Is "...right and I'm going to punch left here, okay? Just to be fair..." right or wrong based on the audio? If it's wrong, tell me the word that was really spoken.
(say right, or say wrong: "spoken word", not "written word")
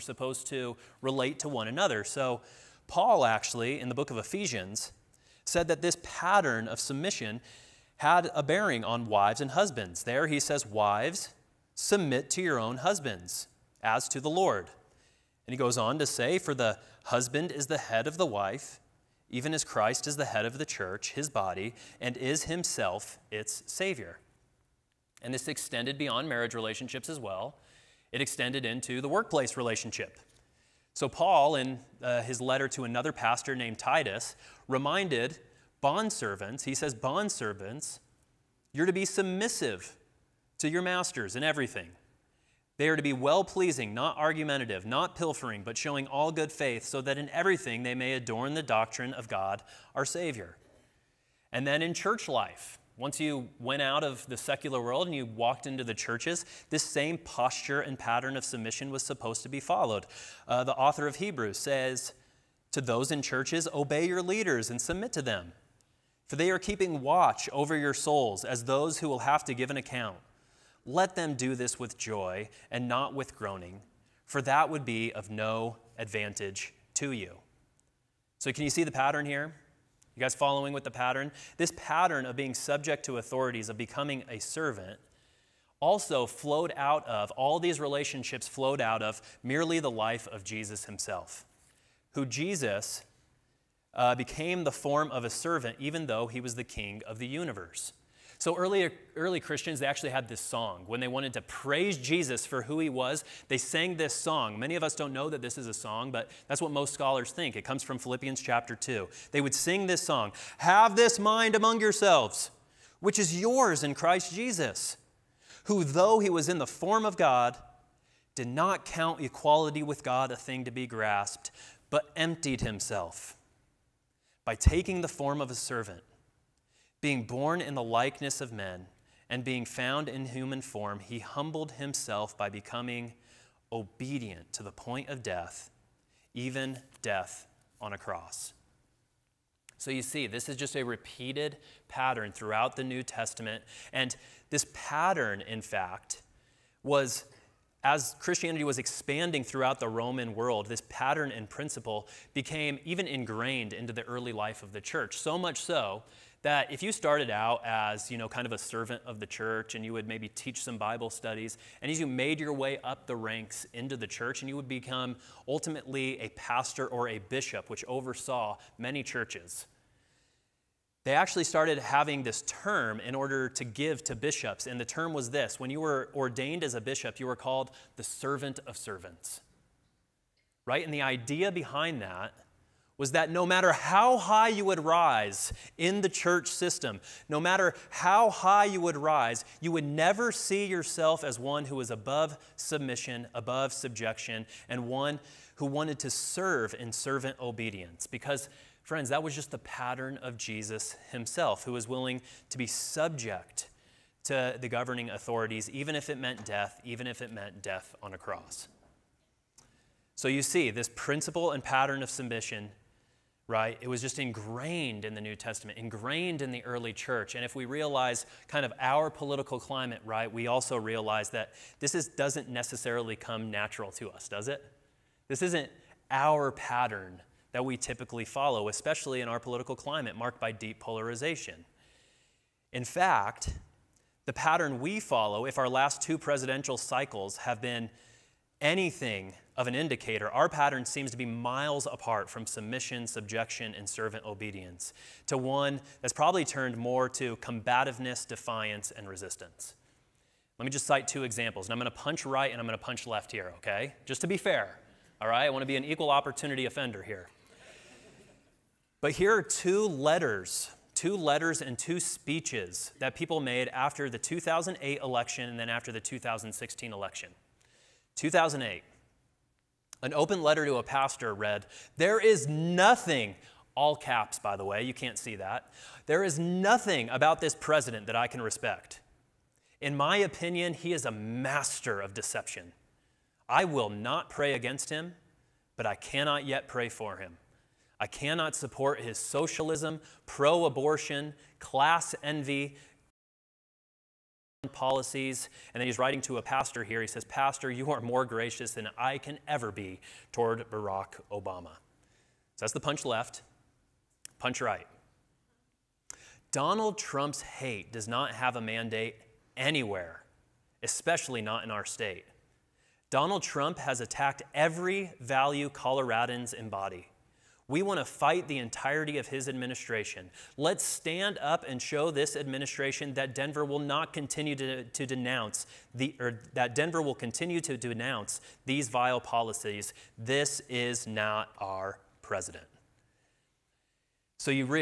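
right.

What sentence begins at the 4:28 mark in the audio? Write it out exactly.
2008, an open letter to a pastor read, There is nothing, all caps, by the way, you can't see that.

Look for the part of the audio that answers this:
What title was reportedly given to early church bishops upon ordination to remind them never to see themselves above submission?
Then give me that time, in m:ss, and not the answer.
2:58.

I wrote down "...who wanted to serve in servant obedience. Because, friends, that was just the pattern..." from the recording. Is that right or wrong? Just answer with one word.
right.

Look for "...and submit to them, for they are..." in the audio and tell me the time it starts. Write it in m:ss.
1:04.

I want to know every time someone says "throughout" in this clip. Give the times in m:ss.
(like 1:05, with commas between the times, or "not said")
2:22, 2:29.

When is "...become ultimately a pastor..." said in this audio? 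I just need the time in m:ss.
2:44.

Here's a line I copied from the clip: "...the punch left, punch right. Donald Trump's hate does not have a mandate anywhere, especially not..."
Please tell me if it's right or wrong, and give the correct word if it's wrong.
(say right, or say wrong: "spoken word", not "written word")
right.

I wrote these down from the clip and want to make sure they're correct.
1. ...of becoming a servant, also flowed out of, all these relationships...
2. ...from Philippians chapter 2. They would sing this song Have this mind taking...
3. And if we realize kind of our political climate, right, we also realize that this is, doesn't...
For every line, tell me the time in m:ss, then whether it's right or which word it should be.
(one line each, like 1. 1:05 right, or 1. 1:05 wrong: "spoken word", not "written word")
1. 1:23 right
2. 1:47 wrong: "among", not "taking"
3. 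3:37 right.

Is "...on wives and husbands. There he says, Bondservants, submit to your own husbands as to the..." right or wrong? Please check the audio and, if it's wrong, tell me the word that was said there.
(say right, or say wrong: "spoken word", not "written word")
wrong: "Wives", not "Bondservants".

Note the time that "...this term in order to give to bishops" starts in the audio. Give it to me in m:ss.
2:52.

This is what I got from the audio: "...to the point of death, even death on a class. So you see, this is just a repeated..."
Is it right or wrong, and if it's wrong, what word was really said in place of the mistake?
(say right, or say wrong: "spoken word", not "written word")
wrong: "cross", not "class".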